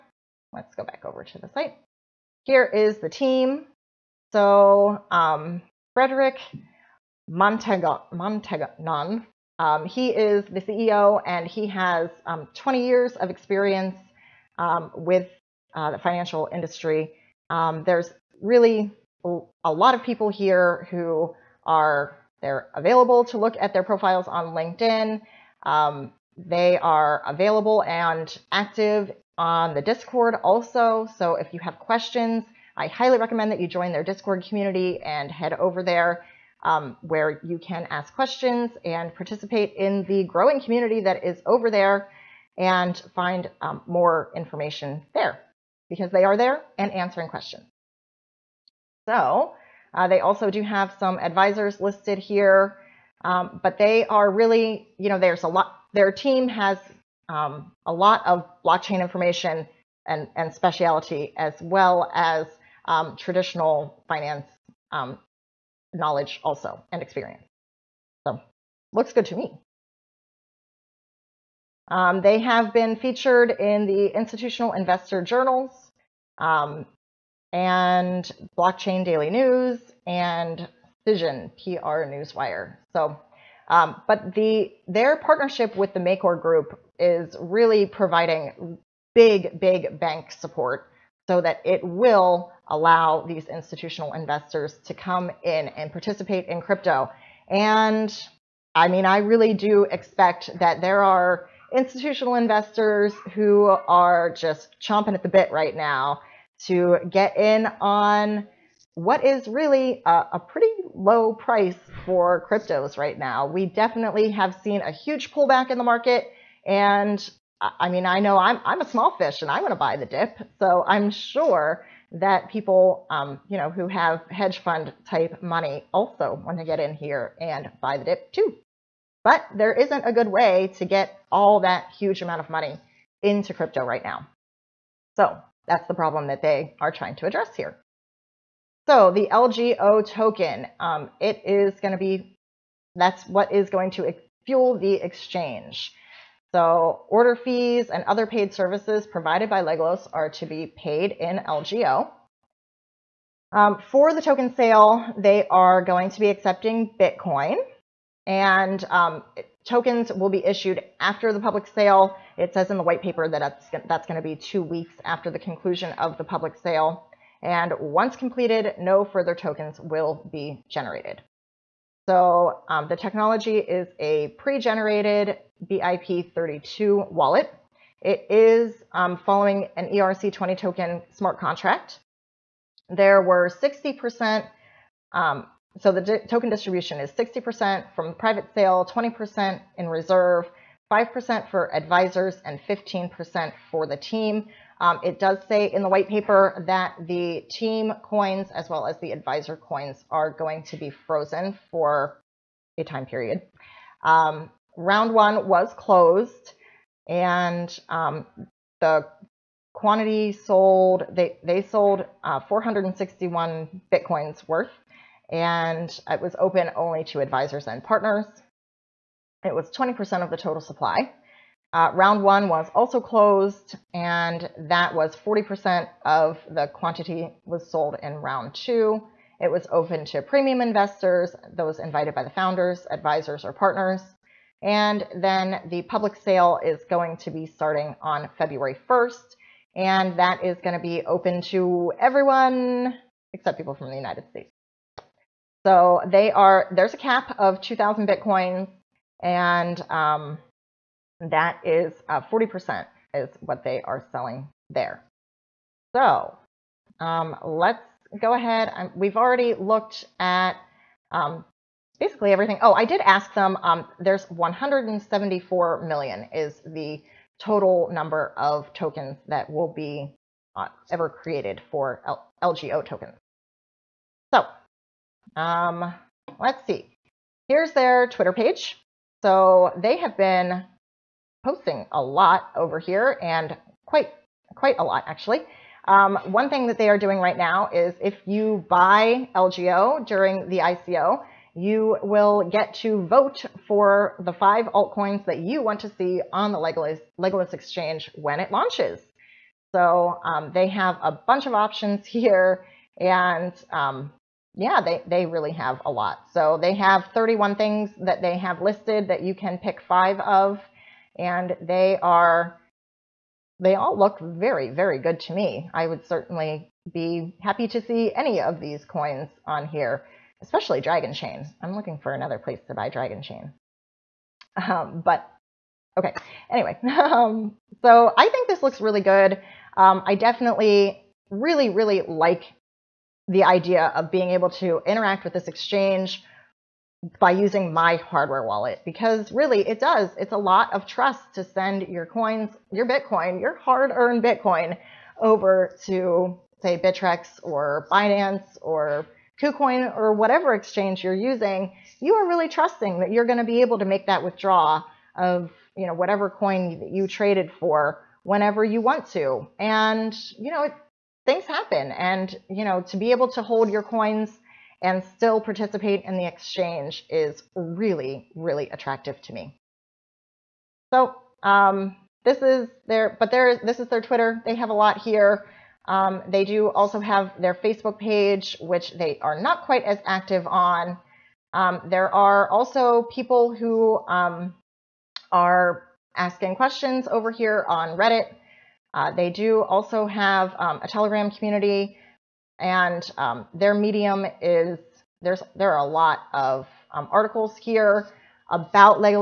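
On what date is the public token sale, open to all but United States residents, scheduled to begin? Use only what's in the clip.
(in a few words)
February 1st.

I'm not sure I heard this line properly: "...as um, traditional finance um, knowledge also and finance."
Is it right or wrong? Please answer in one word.
wrong.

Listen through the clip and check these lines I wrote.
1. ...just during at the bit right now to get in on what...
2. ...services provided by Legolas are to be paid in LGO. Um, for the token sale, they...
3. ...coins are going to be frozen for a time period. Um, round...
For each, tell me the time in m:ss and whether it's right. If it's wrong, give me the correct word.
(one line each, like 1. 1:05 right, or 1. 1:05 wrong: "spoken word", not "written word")
1. 1:44 wrong: "chomping", not "during"
2. 2:28 right
3. 3:19 right.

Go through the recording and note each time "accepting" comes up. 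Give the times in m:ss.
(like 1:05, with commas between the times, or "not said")
2:36.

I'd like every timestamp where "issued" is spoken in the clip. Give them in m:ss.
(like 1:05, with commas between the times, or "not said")
2:40.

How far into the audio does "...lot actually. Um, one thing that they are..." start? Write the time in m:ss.
4:44.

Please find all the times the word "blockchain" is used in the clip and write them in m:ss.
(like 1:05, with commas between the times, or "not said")
0:58, 1:18.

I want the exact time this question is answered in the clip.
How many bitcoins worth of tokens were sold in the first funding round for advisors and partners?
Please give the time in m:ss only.
3:32.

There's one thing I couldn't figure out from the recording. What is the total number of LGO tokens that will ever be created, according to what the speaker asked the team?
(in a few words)
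174 million.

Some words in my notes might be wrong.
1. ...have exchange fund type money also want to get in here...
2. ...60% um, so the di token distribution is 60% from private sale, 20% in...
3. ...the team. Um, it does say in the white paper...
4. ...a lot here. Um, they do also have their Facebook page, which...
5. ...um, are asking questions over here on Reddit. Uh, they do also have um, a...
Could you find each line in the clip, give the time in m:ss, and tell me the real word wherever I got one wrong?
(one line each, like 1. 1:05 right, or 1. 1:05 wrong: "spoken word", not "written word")
1. 2:03 wrong: "hedge", not "exchange"
2. 3:03 right
3. 3:13 right
4. 6:14 right
5. 6:24 right.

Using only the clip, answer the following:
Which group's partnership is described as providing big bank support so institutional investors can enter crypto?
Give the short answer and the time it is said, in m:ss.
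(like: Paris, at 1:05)
Makor Group, at 1:25.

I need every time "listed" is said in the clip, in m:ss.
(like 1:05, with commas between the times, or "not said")
0:51, 5:08.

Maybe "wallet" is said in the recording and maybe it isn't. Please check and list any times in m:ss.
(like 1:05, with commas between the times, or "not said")
2:57, 5:38.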